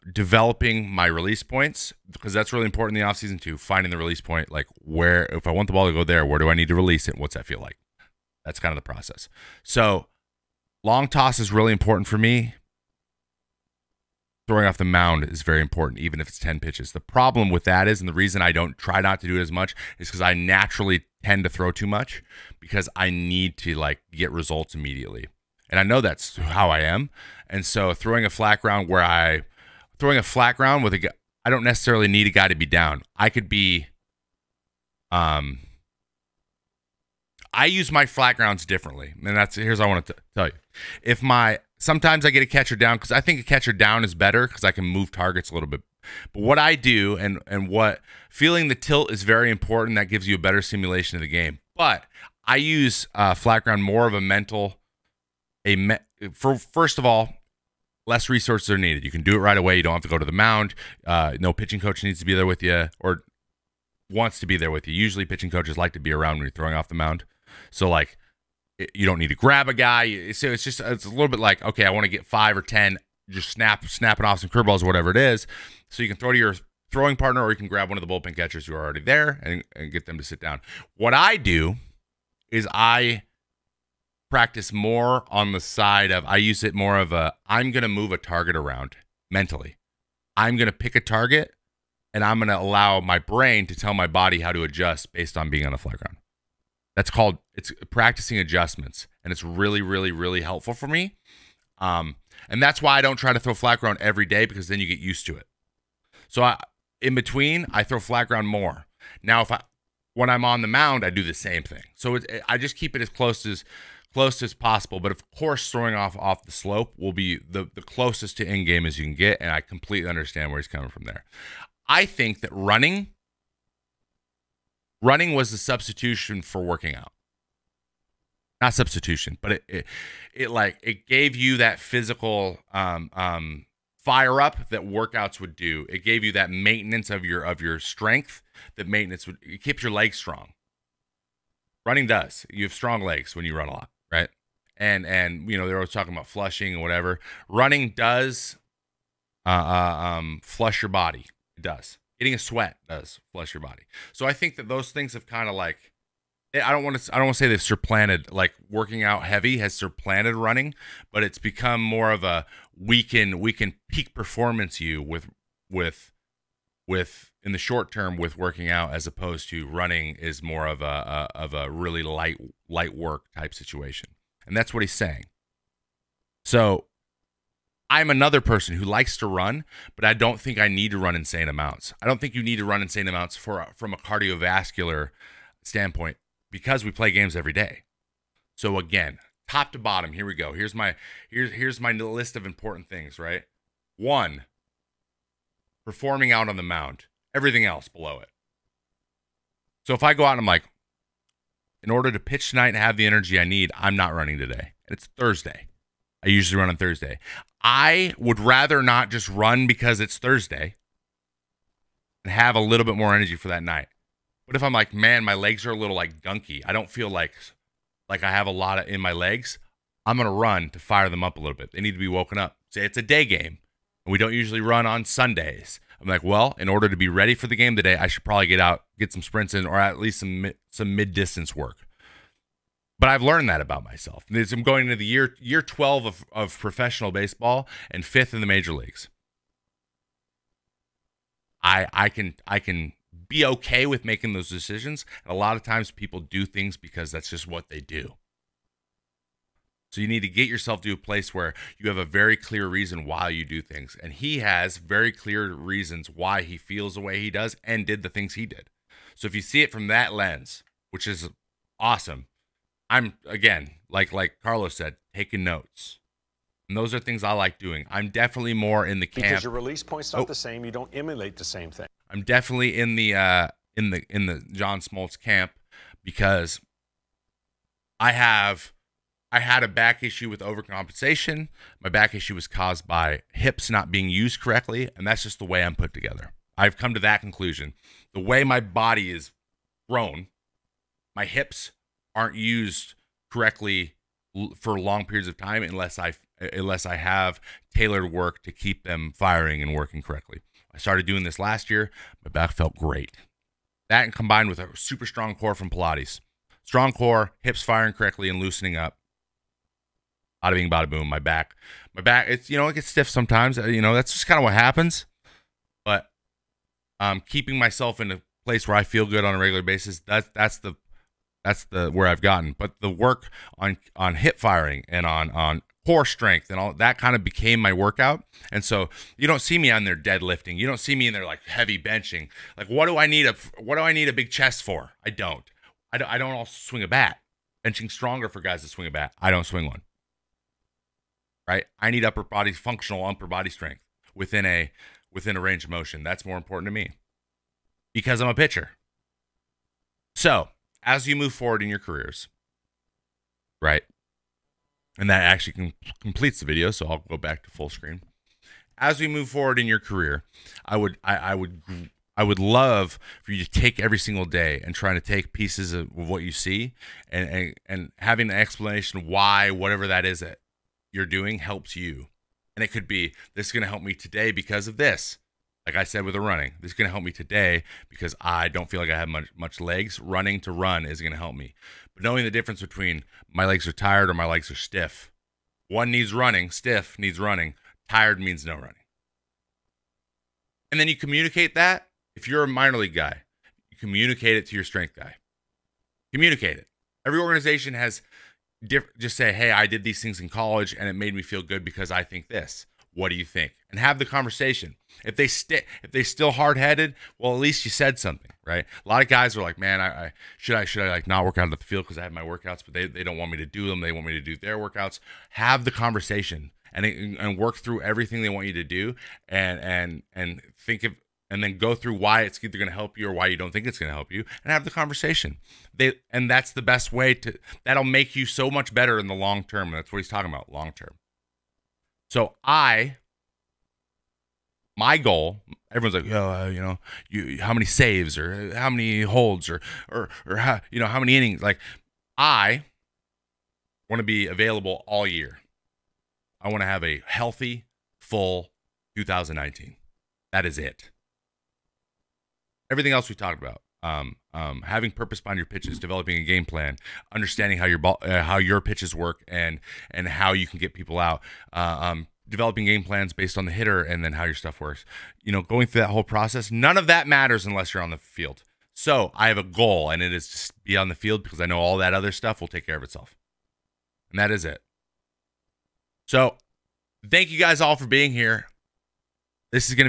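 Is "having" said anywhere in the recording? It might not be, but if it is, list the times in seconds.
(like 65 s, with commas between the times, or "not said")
367 s, 454 s.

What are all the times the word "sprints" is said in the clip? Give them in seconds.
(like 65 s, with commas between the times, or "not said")
229 s.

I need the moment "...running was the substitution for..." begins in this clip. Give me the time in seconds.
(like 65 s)
125 s.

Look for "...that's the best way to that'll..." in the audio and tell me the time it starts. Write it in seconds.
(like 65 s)
426 s.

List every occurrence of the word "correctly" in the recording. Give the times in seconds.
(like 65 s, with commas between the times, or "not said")
284 s, 293 s, 300 s, 307 s.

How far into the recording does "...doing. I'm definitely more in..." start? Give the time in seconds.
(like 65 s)
267 s.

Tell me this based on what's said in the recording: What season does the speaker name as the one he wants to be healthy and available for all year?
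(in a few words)
2019.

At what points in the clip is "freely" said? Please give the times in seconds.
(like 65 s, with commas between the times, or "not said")
not said.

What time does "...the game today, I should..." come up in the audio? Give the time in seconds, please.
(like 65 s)
227 s.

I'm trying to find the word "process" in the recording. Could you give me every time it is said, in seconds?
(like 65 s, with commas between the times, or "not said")
8 s, 466 s.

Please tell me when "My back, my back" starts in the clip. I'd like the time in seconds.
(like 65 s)
311 s.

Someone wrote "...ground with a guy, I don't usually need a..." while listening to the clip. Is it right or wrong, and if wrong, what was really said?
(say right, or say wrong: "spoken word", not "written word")
wrong: "necessarily", not "usually".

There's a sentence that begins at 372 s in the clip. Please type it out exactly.
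And it could be this is going to help me today because of this.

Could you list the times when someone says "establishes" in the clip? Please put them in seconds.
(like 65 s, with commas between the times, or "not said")
not said.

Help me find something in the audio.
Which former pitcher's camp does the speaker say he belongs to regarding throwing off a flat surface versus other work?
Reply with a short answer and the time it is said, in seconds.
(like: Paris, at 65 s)
John Smoltz, at 274 s.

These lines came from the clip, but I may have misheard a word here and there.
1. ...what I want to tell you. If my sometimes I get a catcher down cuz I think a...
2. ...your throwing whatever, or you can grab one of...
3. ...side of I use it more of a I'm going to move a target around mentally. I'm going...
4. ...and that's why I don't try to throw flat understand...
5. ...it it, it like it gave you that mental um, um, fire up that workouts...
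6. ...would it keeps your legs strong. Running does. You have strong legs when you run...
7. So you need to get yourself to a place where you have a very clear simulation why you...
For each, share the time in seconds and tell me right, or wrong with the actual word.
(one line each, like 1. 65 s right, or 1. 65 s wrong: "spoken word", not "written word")
1. 39 s right
2. 76 s wrong: "partner", not "whatever"
3. 85 s right
4. 102 s wrong: "ground", not "understand"
5. 129 s wrong: "physical", not "mental"
6. 139 s right
7. 249 s wrong: "reason", not "simulation".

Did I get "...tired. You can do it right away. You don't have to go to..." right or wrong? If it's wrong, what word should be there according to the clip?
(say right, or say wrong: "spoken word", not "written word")
wrong: "needed", not "tired".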